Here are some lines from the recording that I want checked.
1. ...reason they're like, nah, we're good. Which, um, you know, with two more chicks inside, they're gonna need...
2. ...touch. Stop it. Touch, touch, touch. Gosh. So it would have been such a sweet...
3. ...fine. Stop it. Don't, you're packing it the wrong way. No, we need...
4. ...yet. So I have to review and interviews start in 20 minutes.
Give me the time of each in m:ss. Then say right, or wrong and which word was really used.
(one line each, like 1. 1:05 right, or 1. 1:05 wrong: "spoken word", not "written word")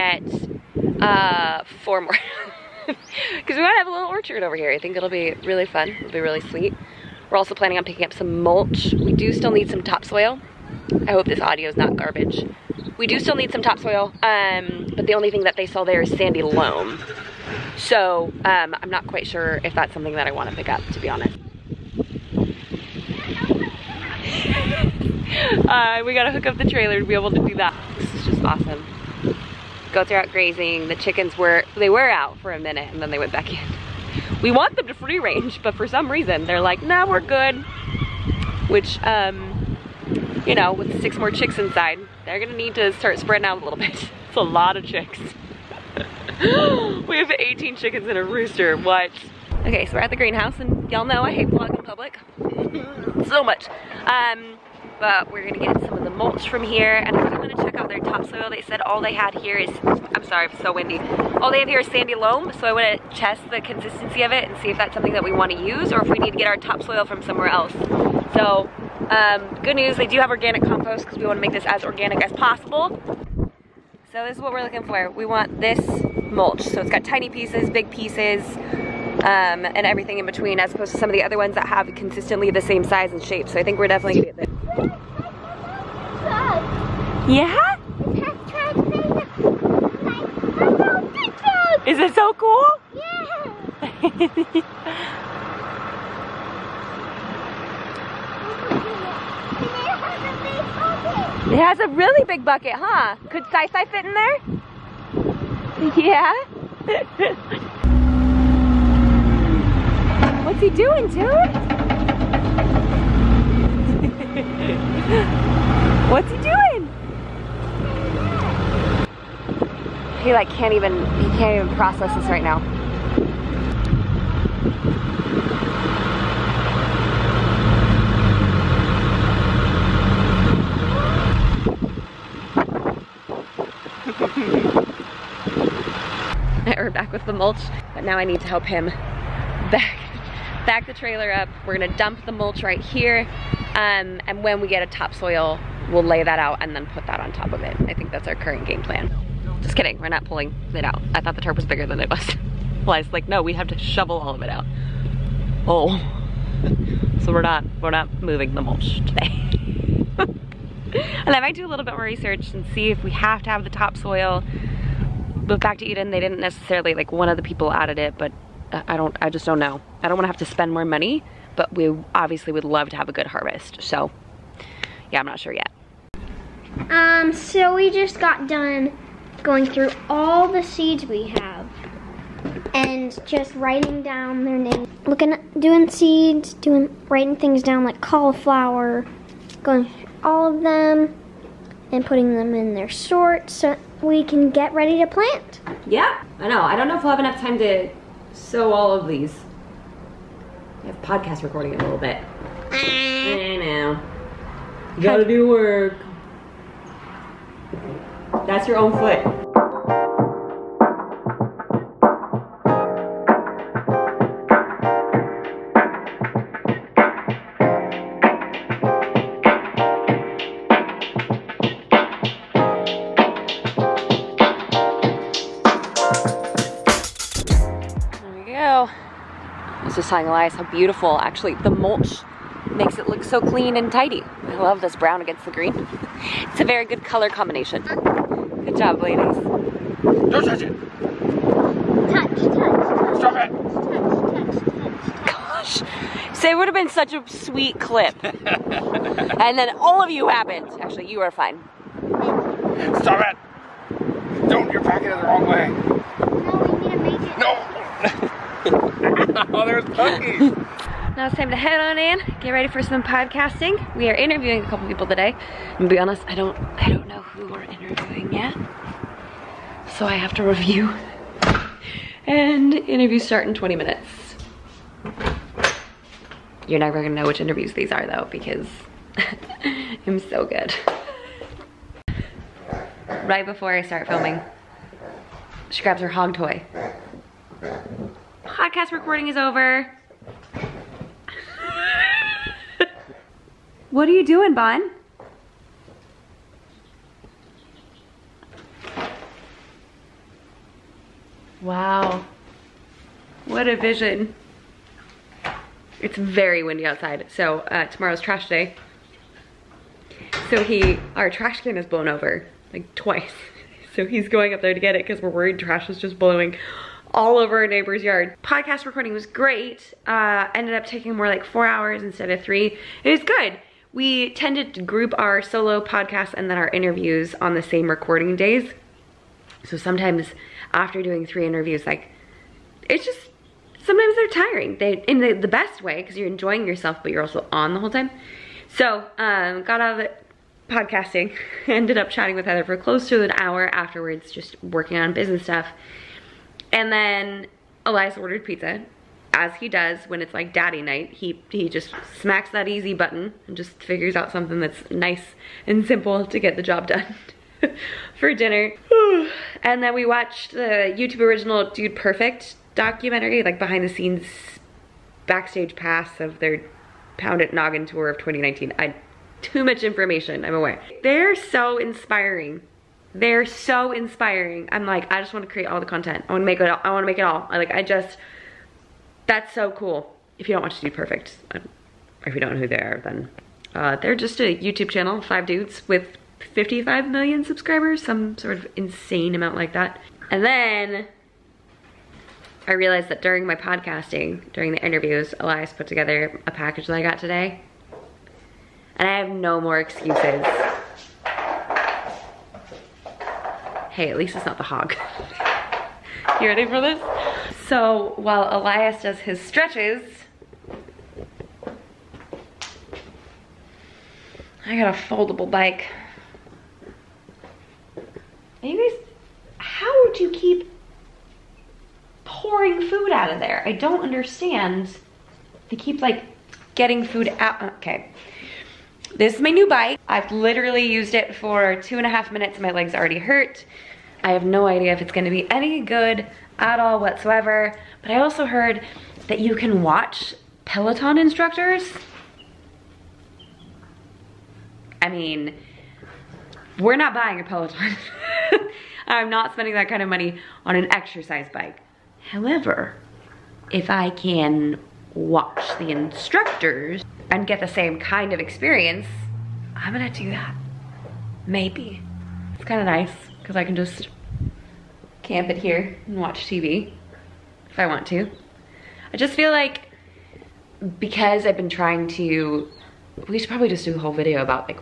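1. 0:36 wrong: "six", not "two"
2. 4:02 right
3. 4:11 right
4. 4:28 right.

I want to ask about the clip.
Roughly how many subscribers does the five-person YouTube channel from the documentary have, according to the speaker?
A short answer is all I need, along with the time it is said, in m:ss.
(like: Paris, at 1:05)
55 million, at 6:26.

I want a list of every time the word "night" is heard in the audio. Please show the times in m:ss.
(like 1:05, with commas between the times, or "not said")
5:50.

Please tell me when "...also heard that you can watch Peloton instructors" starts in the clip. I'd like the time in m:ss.
7:18.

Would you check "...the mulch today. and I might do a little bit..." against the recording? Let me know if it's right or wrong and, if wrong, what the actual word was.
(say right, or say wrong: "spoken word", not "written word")
right.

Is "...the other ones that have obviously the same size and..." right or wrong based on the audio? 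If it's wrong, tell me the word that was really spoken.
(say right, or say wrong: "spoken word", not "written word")
wrong: "consistently", not "obviously".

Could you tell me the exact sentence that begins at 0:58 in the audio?
They said all they had here is, I'm sorry, it's so windy.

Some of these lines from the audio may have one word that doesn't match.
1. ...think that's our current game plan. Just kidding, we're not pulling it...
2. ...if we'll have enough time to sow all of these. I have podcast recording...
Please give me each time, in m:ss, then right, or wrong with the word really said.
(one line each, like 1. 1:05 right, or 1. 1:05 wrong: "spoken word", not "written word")
1. 2:27 right
2. 3:16 right.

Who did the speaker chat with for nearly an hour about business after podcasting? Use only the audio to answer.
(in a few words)
Heather.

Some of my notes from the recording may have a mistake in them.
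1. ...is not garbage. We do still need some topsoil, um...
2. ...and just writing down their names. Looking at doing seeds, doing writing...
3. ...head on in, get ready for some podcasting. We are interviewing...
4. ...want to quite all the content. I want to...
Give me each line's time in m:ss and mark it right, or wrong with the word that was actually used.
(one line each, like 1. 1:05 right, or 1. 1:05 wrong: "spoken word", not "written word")
1. 0:11 right
2. 3:02 right
3. 4:21 right
4. 6:15 wrong: "create", not "quite".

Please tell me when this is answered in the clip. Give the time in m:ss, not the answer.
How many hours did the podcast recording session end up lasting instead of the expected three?
5:21.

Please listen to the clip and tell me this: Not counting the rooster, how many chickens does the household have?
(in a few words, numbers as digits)
18.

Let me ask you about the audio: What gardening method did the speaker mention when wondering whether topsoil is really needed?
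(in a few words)
Back to Eden.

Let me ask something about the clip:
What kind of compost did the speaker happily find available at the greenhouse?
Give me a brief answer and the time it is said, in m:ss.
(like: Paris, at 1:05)
organic compost, at 1:10.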